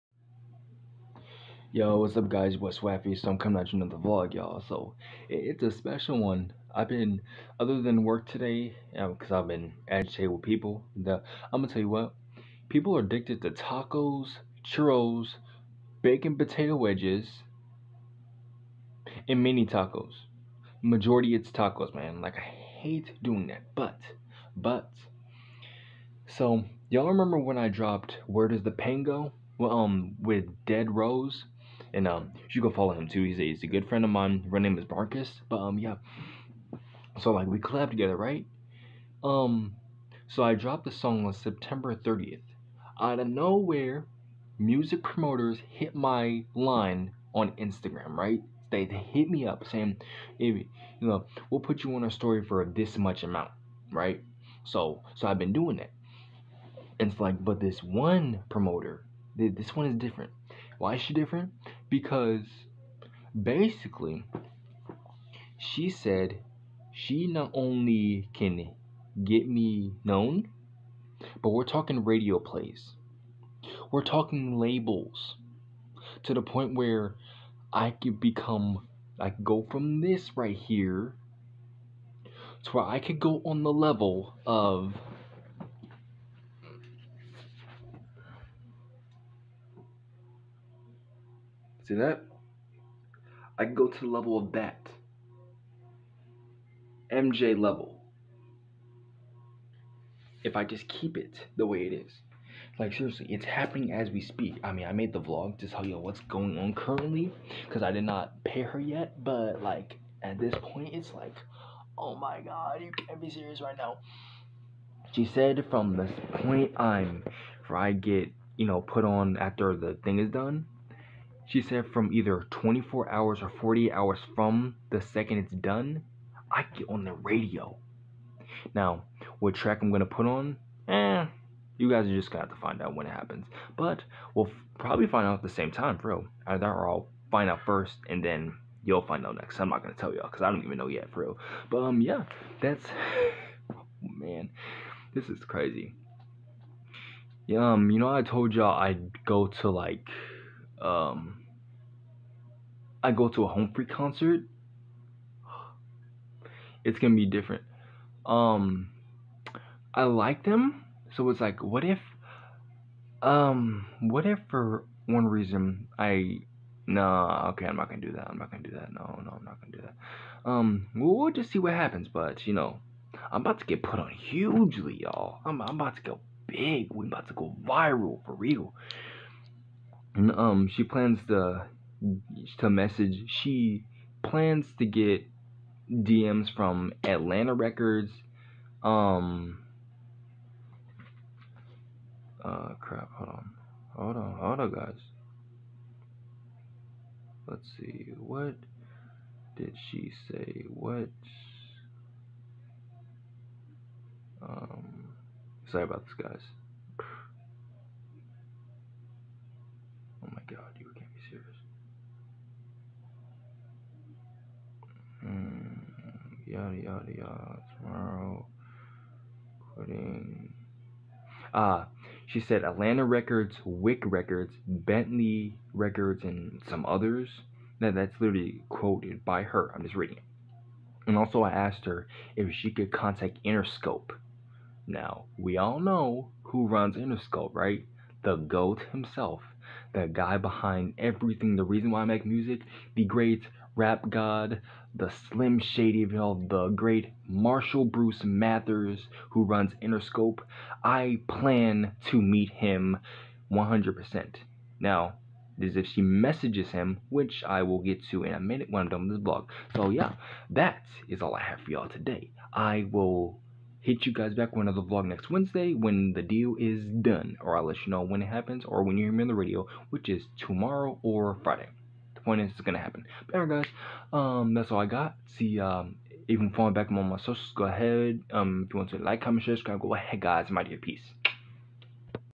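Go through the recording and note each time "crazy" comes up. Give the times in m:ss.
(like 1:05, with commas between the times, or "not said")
2:25.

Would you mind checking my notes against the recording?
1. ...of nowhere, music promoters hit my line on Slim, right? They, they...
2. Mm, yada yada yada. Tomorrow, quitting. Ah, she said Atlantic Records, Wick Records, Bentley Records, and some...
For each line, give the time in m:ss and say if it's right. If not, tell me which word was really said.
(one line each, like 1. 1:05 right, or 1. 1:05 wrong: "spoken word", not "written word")
1. 0:43 wrong: "Instagram", not "Slim"
2. 3:35 right.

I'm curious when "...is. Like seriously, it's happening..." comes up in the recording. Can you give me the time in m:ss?
1:41.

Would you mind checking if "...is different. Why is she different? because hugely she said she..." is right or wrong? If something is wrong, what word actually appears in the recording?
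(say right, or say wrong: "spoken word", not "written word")
wrong: "basically", not "hugely".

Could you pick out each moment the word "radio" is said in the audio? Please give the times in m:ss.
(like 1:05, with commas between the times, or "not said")
1:12, 2:07, 4:29.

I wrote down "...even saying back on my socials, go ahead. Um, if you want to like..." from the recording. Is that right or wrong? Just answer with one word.
wrong.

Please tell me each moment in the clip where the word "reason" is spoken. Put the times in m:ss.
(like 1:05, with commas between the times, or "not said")
2:45, 4:01.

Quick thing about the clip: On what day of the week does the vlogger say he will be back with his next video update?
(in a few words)
Wednesday.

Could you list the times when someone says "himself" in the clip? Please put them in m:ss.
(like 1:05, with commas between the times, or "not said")
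3:58.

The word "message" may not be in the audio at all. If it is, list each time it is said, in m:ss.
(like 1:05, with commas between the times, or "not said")
3:02, 4:16.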